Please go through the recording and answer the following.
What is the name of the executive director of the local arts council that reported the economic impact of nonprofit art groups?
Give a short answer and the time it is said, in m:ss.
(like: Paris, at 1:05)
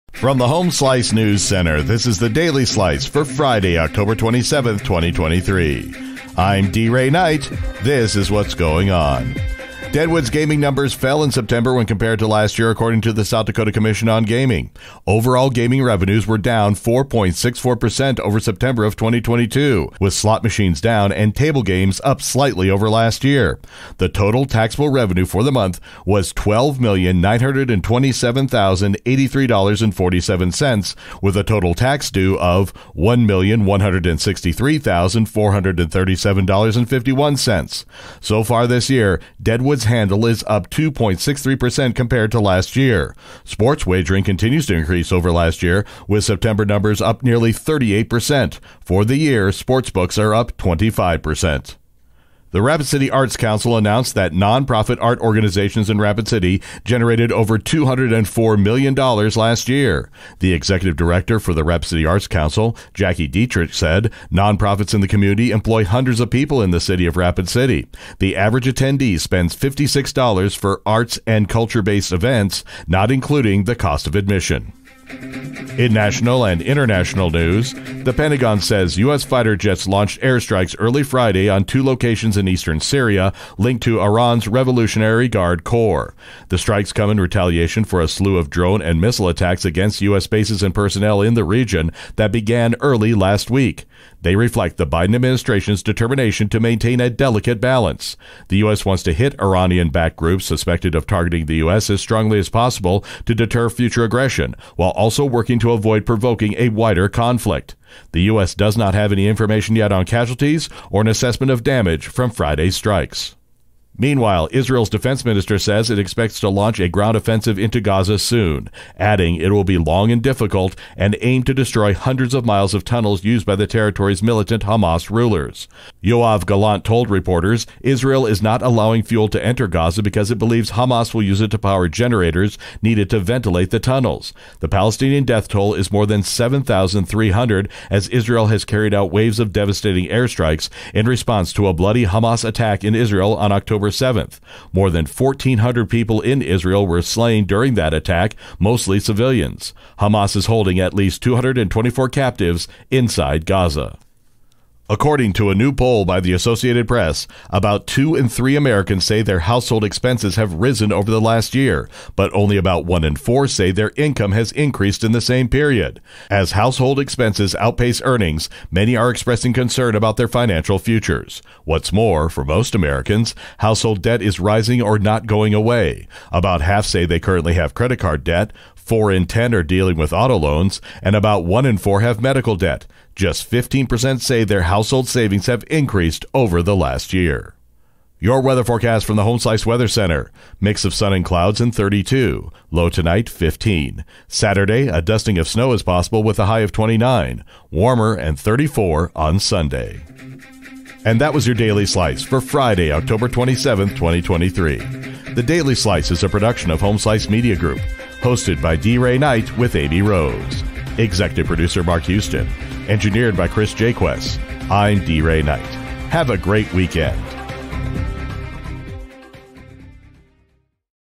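Jackie Dietrich, at 1:02.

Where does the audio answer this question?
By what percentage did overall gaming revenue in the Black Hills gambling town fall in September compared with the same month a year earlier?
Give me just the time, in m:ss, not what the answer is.
0:16.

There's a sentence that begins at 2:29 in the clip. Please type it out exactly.
Hamas is holding at least 224 captives inside Gaza.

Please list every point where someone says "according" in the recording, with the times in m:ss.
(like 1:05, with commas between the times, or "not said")
0:12, 2:34.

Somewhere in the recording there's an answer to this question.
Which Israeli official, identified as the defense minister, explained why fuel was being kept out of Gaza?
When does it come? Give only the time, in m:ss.
2:06.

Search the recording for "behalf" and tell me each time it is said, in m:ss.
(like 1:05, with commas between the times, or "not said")
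not said.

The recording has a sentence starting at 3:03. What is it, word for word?
Just 15% say their household savings have increased over the last year.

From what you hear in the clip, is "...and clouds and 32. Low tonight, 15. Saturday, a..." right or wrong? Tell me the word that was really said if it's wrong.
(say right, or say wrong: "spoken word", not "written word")
right.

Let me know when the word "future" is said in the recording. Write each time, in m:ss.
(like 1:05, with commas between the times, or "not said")
1:43, 2:50.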